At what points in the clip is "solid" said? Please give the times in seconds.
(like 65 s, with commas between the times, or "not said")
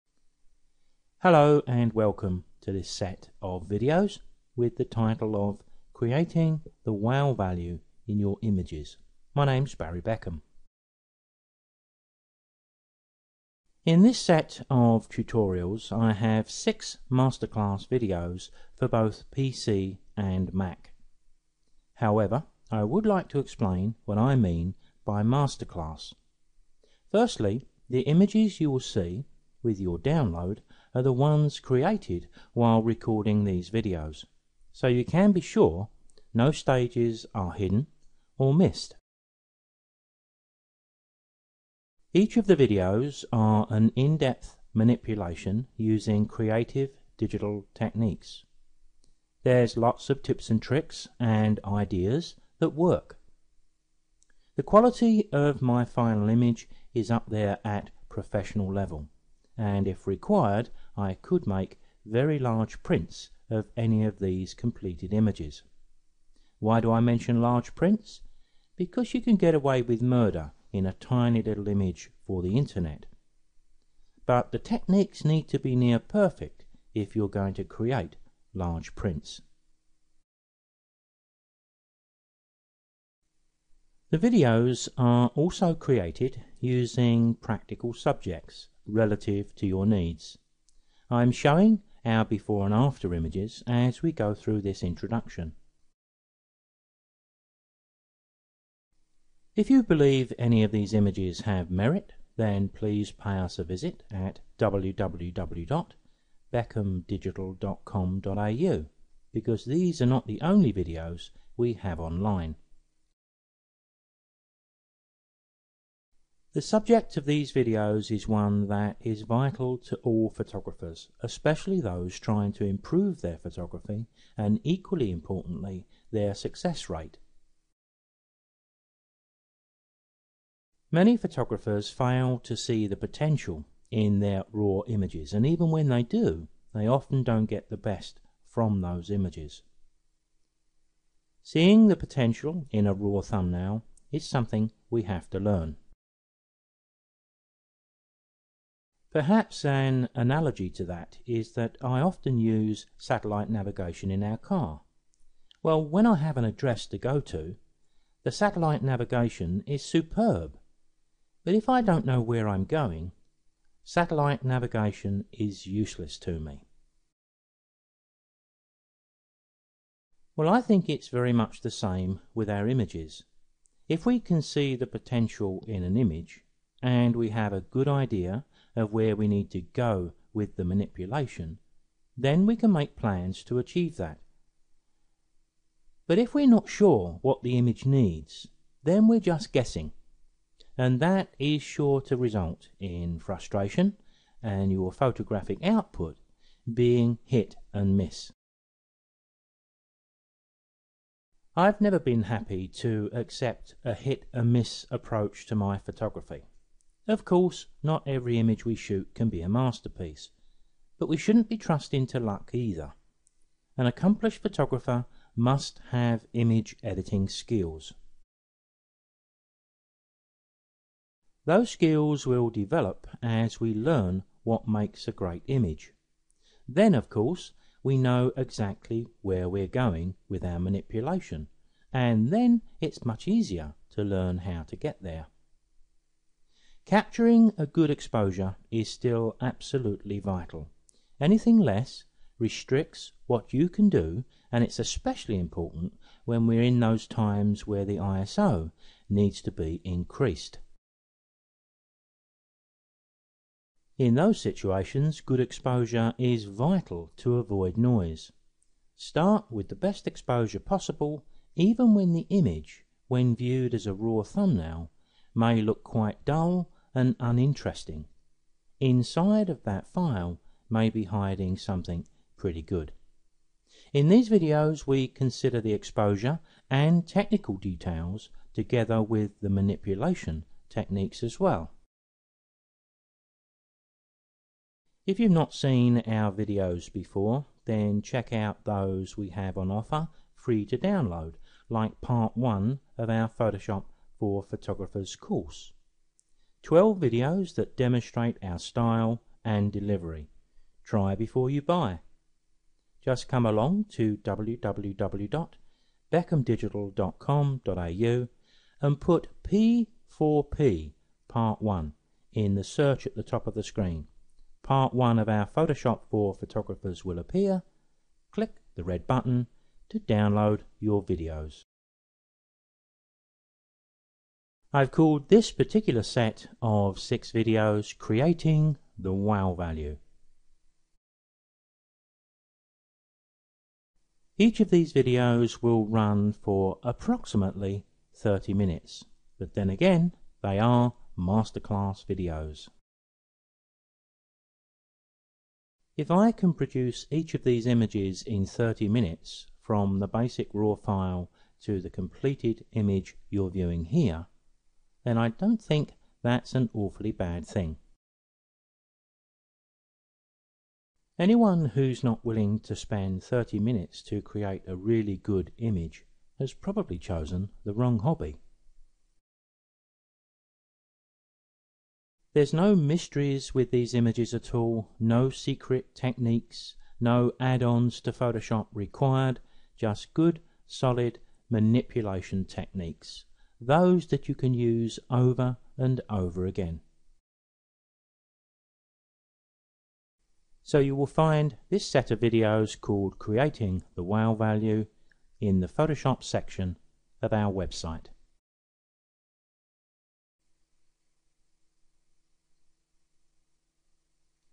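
380 s.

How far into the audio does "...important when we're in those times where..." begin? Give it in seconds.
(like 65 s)
245 s.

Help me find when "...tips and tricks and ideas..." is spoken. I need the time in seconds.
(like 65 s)
50 s.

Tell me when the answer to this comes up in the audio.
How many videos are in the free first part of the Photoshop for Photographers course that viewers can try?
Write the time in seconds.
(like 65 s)
296 s.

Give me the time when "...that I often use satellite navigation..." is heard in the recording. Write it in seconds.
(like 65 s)
151 s.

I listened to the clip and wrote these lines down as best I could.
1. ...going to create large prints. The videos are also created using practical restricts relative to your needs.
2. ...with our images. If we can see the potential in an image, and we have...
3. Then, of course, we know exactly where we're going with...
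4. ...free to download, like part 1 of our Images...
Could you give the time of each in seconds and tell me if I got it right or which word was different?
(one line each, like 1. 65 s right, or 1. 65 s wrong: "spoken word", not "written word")
1. 77 s wrong: "subjects", not "restricts"
2. 172 s right
3. 226 s right
4. 290 s wrong: "Photoshop", not "Images".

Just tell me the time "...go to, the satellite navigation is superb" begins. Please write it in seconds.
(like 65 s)
156 s.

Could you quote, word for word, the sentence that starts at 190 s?
And that is sure to result in frustration and your photographic output being hit and miss.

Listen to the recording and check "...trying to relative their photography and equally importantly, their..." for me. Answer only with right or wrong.
wrong.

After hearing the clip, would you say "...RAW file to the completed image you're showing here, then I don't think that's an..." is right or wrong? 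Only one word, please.
wrong.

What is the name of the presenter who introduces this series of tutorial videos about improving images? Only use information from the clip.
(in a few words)
Barry Beckham.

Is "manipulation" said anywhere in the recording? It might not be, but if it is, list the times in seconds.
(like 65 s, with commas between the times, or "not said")
44 s, 180 s, 230 s, 279 s, 381 s.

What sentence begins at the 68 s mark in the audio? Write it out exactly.
Because you can get away with murder in a tiny little image for the internet.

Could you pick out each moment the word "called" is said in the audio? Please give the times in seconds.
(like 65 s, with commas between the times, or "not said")
324 s, 392 s.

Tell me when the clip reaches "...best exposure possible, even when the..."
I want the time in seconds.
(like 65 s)
259 s.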